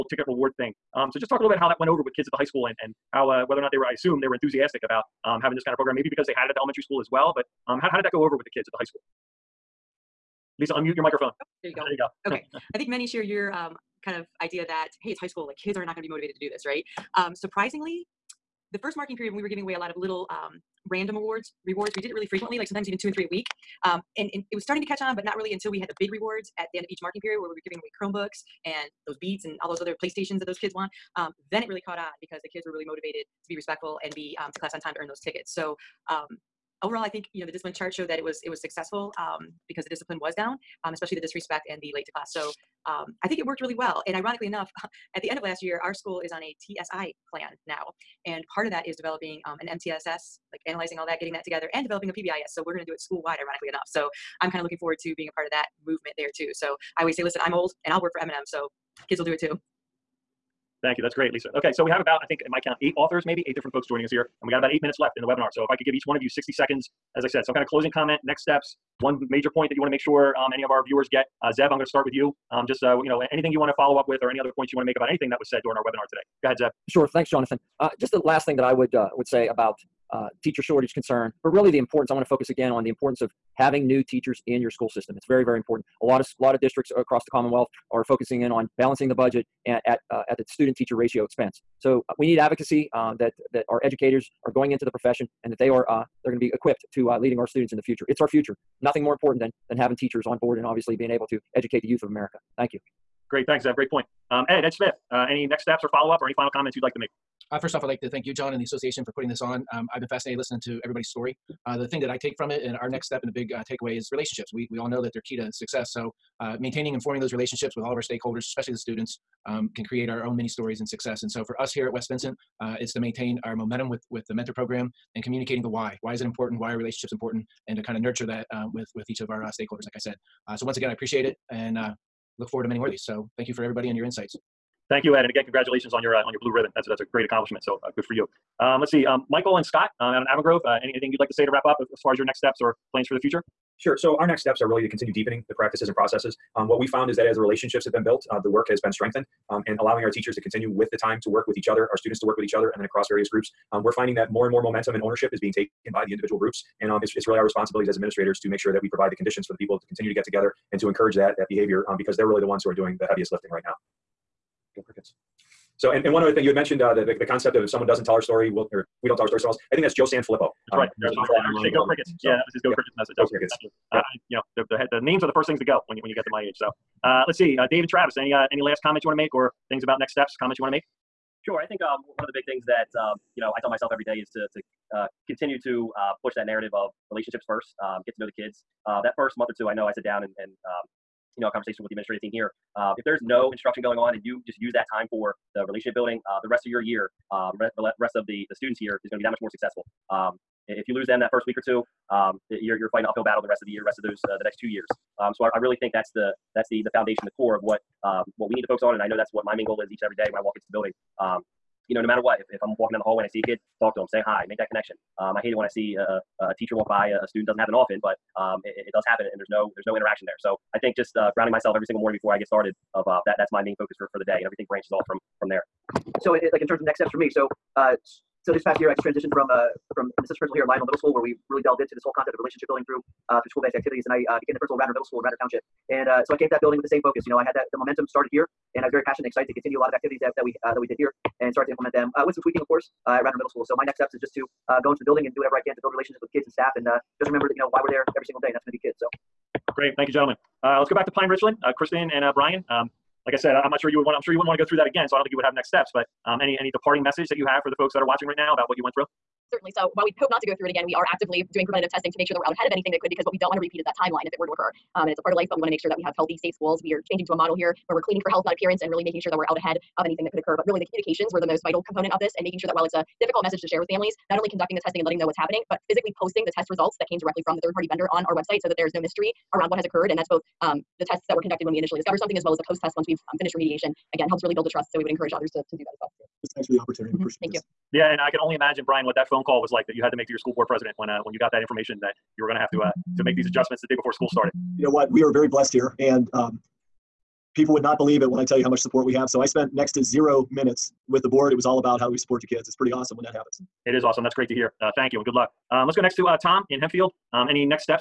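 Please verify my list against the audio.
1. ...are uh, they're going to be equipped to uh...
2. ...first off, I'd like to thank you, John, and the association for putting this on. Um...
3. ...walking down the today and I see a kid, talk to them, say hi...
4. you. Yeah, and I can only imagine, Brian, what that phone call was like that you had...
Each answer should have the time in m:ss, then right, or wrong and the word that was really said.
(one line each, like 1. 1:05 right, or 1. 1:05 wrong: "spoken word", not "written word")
1. 1:35 right
2. 1:47 right
3. 3:32 wrong: "hallway", not "today"
4. 4:47 right.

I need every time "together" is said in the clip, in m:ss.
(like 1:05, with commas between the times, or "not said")
0:51, 2:40.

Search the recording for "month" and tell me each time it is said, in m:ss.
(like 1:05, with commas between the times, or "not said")
3:09.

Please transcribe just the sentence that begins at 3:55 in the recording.
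And uh, so I came to that building with the same focus.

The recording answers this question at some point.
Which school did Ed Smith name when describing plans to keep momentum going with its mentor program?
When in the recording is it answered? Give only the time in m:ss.
2:01.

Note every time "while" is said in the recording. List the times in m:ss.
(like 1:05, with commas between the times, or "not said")
4:19, 4:32.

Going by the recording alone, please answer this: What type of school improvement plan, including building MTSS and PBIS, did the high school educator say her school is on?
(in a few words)
TSI plan.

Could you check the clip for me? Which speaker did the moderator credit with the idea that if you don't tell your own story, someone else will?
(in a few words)
Joe Sanfelippo.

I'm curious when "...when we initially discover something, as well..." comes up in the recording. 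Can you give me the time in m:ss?
4:41.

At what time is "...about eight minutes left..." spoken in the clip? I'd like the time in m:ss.
1:04.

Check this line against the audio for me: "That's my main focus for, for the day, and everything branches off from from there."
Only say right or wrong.
right.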